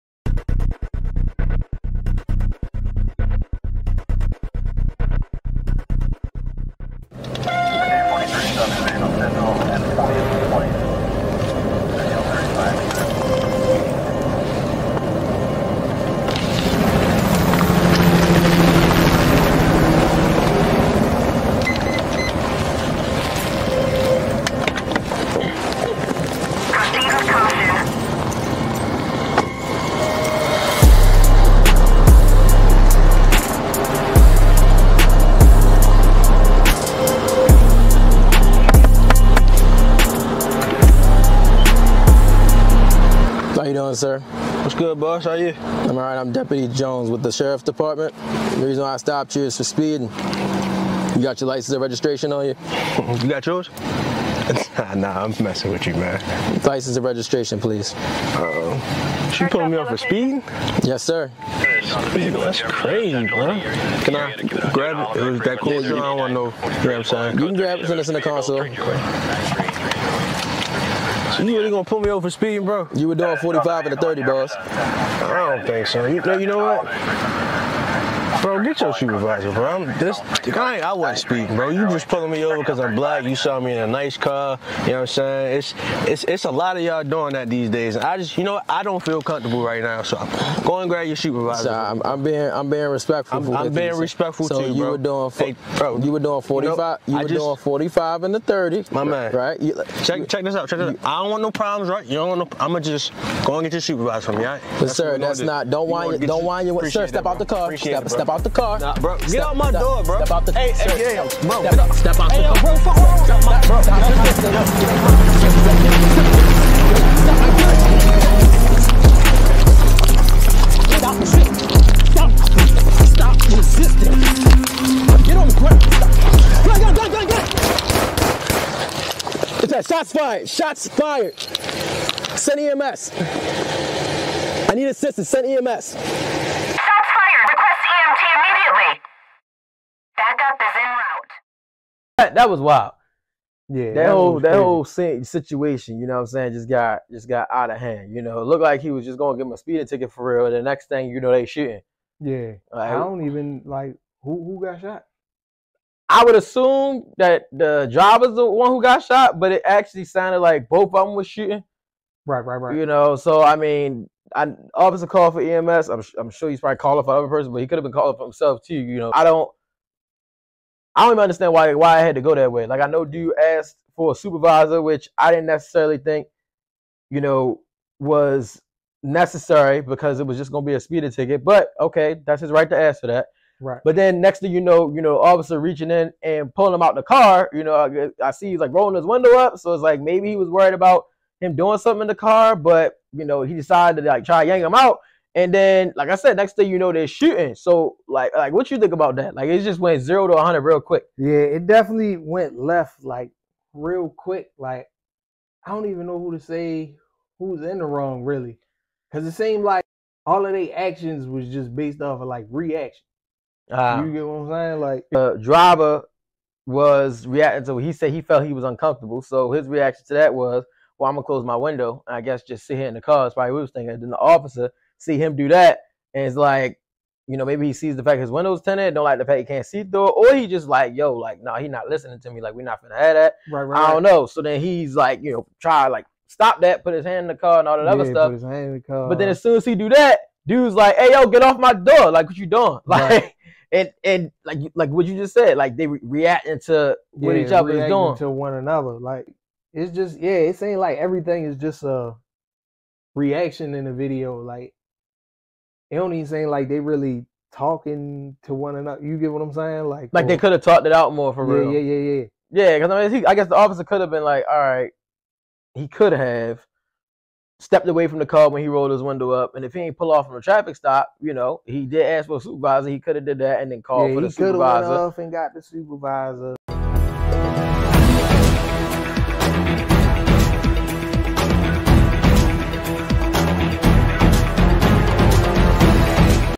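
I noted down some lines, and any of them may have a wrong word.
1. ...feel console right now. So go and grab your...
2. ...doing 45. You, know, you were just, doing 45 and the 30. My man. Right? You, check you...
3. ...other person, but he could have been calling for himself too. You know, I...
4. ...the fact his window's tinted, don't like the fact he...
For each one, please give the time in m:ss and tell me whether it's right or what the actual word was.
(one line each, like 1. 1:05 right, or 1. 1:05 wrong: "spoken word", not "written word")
1. 1:29 wrong: "comfortable", not "console"
2. 1:36 right
3. 2:47 right
4. 3:47 right.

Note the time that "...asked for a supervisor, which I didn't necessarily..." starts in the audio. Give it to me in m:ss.
2:53.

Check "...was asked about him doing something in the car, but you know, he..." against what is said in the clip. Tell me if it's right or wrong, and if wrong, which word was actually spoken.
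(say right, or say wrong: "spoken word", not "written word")
wrong: "worried", not "asked".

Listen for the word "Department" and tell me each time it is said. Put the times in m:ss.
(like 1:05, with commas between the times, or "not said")
0:47.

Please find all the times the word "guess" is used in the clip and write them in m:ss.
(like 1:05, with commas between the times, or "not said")
3:42, 4:23.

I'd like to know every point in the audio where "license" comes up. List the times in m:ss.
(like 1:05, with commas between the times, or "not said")
0:51, 0:56.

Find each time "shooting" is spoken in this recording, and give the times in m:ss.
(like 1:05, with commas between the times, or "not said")
2:31, 2:41, 3:17.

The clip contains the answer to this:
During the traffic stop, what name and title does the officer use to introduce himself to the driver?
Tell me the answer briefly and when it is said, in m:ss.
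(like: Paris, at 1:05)
Deputy Jones, at 0:46.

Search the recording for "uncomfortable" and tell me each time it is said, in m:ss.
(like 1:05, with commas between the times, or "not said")
3:38.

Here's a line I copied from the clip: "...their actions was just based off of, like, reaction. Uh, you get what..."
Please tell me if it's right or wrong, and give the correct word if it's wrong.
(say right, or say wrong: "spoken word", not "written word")
right.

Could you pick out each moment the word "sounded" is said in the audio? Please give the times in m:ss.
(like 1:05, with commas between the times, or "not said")
2:40.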